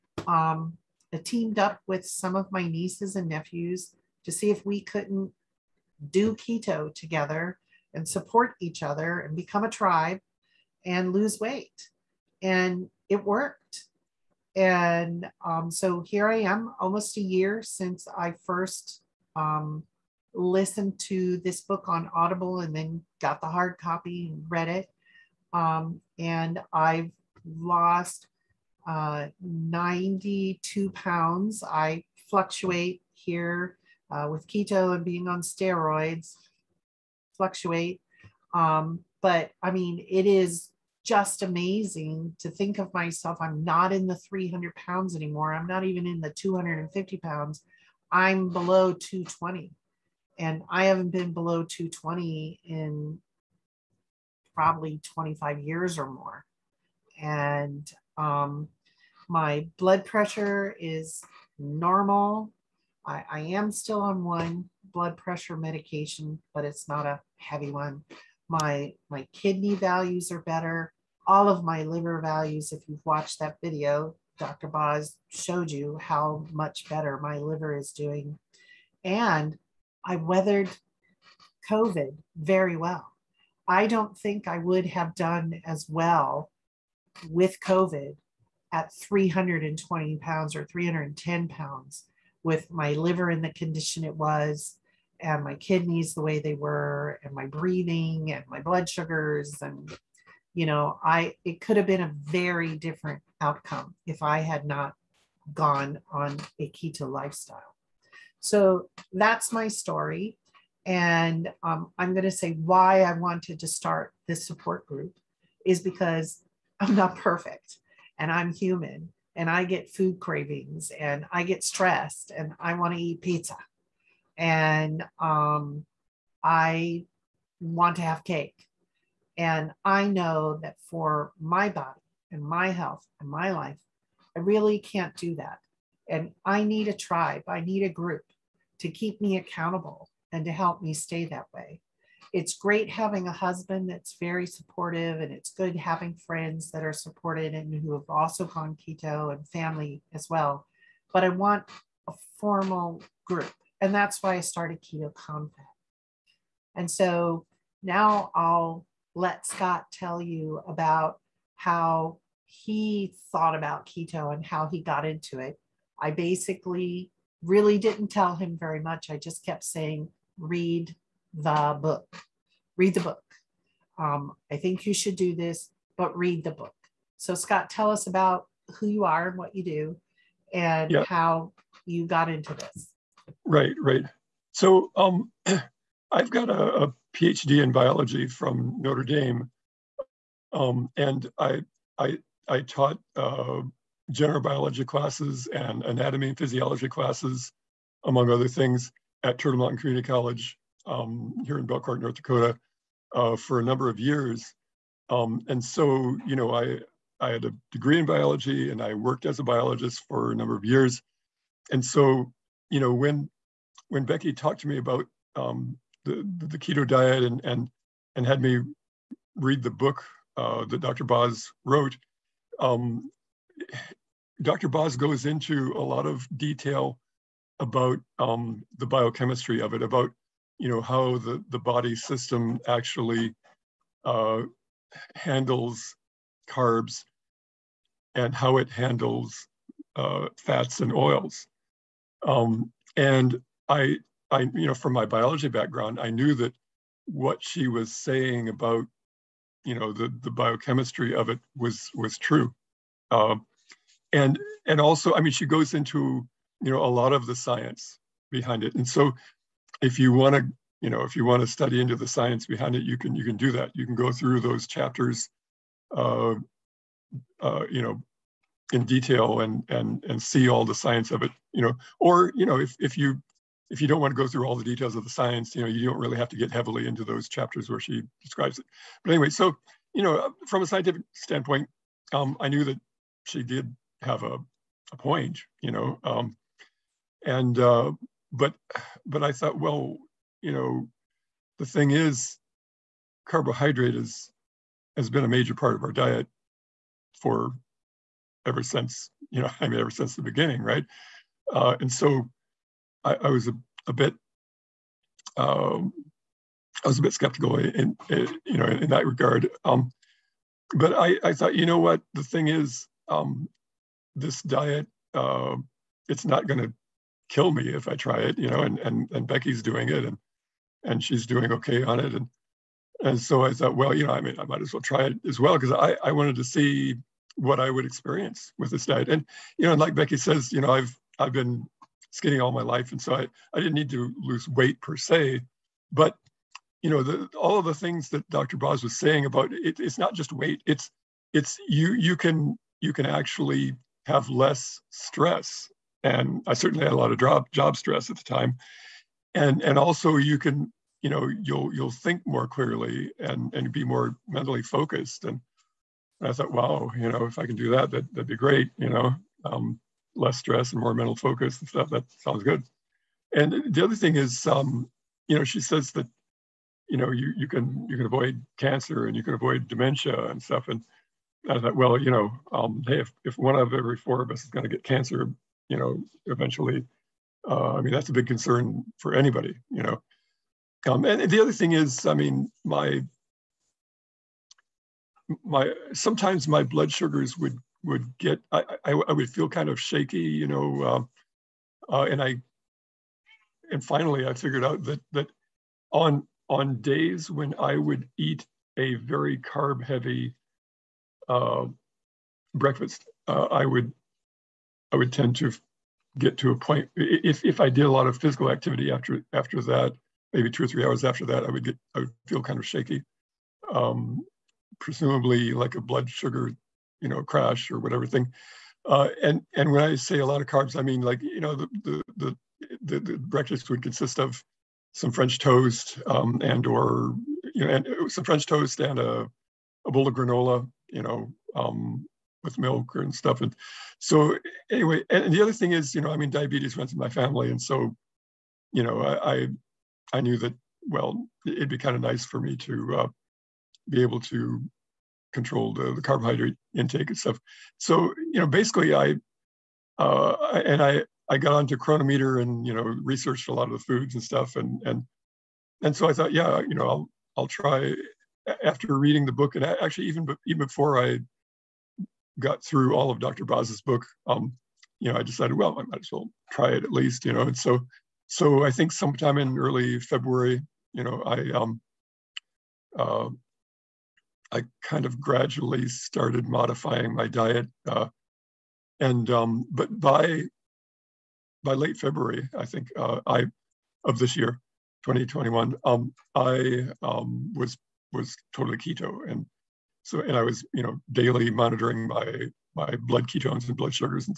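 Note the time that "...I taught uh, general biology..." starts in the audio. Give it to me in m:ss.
3:12.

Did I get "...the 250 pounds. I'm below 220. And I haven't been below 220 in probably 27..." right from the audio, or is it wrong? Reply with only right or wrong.
wrong.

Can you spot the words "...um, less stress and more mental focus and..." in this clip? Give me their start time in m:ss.
5:59.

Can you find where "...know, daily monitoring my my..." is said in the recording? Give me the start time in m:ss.
8:10.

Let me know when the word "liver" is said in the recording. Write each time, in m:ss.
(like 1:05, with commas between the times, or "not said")
1:11, 1:17, 1:32.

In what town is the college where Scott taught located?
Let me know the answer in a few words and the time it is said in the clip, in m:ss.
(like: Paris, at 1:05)
Belcourt, at 3:21.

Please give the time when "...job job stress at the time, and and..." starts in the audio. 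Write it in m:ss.
5:47.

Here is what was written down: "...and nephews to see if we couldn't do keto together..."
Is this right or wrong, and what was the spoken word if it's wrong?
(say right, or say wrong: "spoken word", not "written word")
right.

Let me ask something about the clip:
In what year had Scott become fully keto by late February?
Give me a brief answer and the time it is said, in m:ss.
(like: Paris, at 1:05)
2021, at 8:05.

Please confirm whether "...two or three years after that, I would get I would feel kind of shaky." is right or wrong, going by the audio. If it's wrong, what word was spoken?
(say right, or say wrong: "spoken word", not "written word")
wrong: "hours", not "years".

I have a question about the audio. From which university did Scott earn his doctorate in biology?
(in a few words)
Notre Dame.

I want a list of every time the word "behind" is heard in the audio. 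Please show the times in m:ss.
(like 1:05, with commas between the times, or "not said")
4:18, 4:22.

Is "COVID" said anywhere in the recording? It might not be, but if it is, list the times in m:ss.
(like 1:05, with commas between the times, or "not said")
1:21, 1:27.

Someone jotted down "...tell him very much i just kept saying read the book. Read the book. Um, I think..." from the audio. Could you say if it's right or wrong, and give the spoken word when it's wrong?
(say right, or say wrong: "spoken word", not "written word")
right.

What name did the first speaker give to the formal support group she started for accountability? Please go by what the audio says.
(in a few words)
Keto Confab.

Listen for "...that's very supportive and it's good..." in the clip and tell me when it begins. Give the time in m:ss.
2:23.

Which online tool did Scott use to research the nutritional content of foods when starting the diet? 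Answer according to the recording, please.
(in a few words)
Cronometer.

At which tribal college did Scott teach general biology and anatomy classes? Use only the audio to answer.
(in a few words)
Turtle Mountain Community College.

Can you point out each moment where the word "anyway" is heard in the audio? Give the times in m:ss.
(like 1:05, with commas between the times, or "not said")
4:39, 7:14.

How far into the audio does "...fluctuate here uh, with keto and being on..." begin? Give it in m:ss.
0:32.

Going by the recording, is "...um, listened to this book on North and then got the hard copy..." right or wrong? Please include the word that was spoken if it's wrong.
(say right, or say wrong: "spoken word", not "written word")
wrong: "Audible", not "North".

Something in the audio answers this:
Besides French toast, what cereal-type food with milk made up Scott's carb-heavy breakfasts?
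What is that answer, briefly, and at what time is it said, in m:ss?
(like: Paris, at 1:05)
granola, at 7:10.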